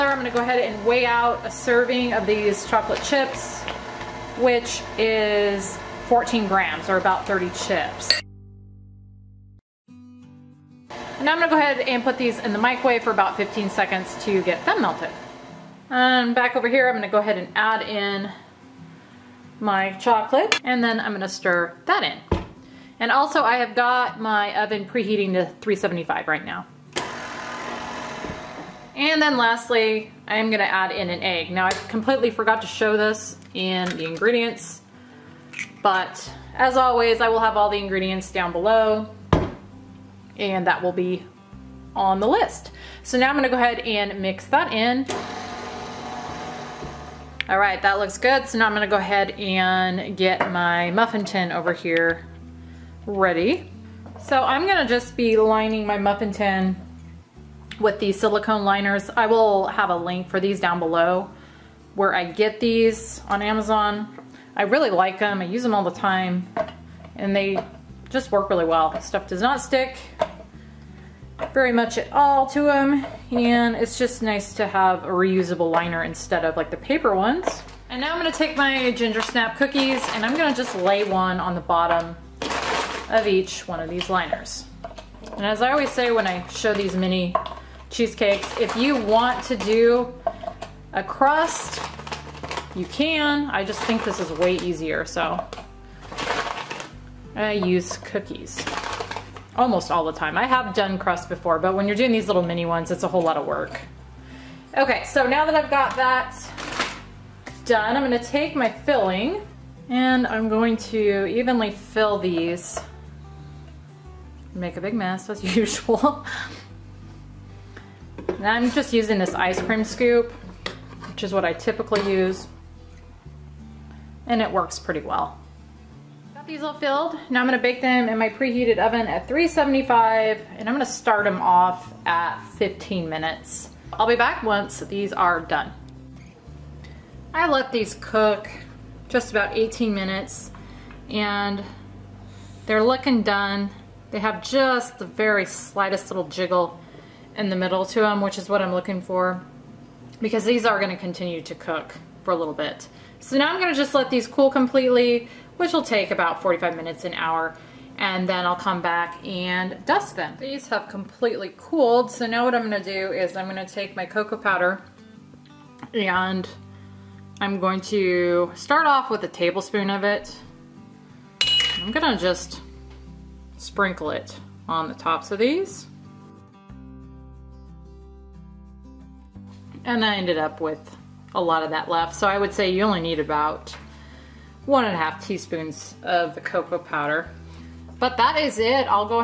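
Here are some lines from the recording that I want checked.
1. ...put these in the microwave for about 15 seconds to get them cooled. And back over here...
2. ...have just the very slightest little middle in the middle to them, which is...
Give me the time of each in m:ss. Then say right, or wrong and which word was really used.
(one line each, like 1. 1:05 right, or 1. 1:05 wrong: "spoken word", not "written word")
1. 0:12 wrong: "melted", not "cooled"
2. 2:24 wrong: "jiggle", not "middle".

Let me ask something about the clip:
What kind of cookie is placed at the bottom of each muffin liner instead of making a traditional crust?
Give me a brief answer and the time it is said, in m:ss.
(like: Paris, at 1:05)
ginger snap, at 1:18.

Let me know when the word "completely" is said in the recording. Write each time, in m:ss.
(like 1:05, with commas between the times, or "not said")
0:31, 2:34, 2:40.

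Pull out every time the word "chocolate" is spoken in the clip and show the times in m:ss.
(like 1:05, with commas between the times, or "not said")
0:02, 0:19.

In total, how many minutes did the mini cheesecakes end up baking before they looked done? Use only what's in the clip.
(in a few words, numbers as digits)
18 minutes.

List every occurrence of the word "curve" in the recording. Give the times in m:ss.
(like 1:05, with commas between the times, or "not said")
not said.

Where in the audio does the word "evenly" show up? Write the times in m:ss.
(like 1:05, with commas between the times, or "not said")
1:51.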